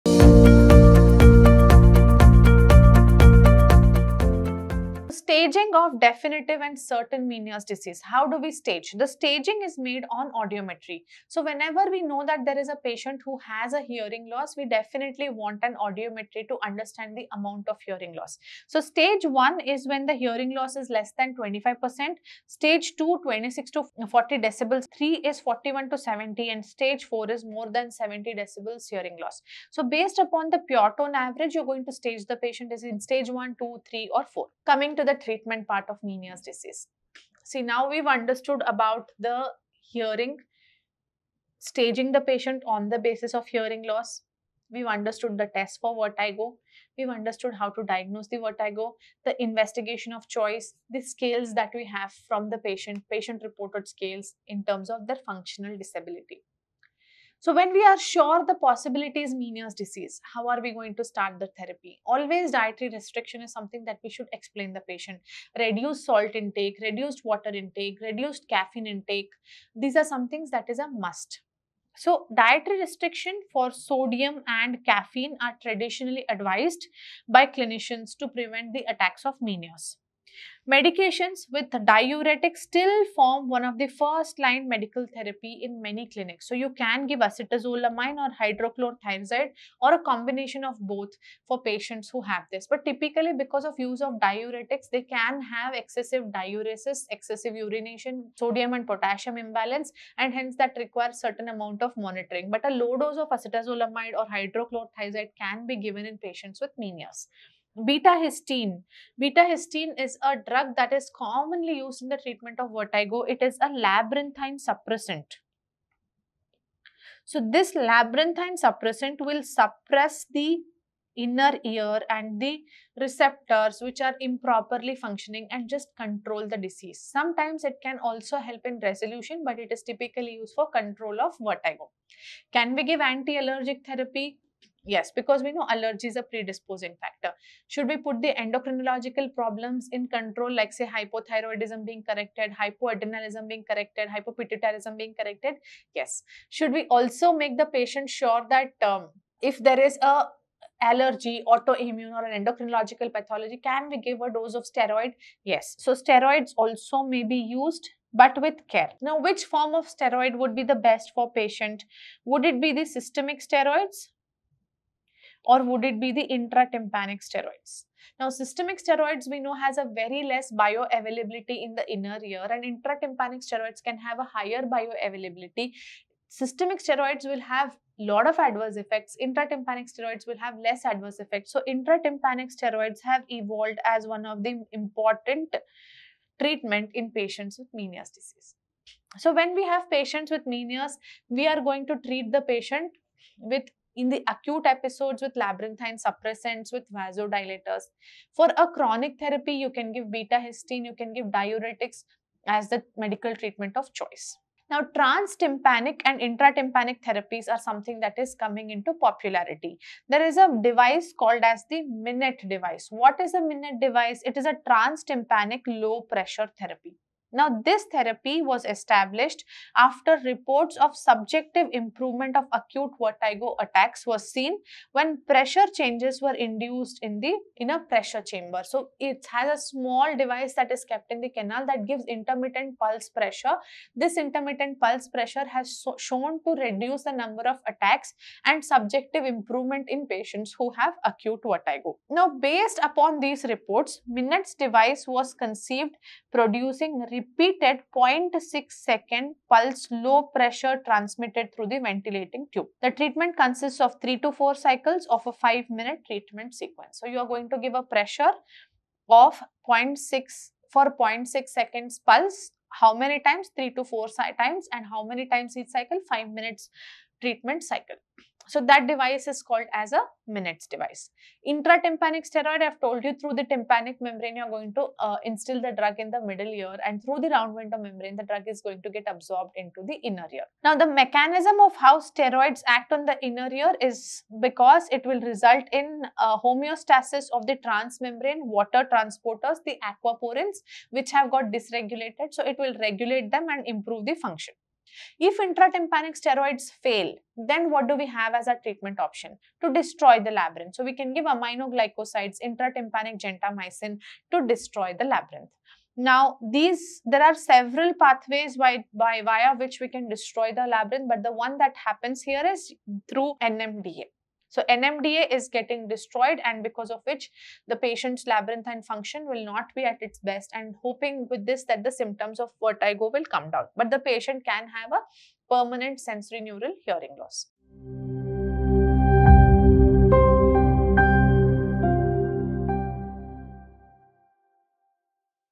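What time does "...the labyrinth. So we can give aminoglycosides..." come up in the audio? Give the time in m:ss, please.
5:00.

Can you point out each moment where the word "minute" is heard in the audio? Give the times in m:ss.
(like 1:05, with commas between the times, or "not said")
4:15, 4:26.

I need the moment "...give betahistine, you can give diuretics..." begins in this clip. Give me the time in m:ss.
3:19.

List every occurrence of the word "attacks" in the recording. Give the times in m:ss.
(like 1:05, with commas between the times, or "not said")
1:18, 3:43, 3:57.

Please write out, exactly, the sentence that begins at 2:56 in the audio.
Systemic steroids will have lot of adverse effects.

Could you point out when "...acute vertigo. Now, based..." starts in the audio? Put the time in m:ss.
4:01.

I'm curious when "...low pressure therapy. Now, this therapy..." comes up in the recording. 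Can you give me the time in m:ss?
3:35.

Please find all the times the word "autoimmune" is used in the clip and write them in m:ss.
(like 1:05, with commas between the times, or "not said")
2:31.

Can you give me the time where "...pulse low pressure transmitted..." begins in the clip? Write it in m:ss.
4:09.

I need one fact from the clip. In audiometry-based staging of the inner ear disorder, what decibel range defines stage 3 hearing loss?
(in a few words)
41 to 70 decibels.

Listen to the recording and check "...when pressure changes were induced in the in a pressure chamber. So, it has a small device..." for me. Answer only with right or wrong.
right.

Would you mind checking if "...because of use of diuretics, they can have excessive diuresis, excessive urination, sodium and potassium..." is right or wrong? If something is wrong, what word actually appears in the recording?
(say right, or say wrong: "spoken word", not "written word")
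right.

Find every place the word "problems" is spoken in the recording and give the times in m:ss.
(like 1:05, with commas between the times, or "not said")
2:19.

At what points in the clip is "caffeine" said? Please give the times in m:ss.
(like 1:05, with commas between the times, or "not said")
1:08, 1:14.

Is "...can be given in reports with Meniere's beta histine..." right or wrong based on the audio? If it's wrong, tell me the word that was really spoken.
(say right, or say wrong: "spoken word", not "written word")
wrong: "patients", not "reports".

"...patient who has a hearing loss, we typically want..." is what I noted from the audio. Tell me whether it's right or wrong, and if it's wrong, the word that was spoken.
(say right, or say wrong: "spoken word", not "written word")
wrong: "definitely", not "typically".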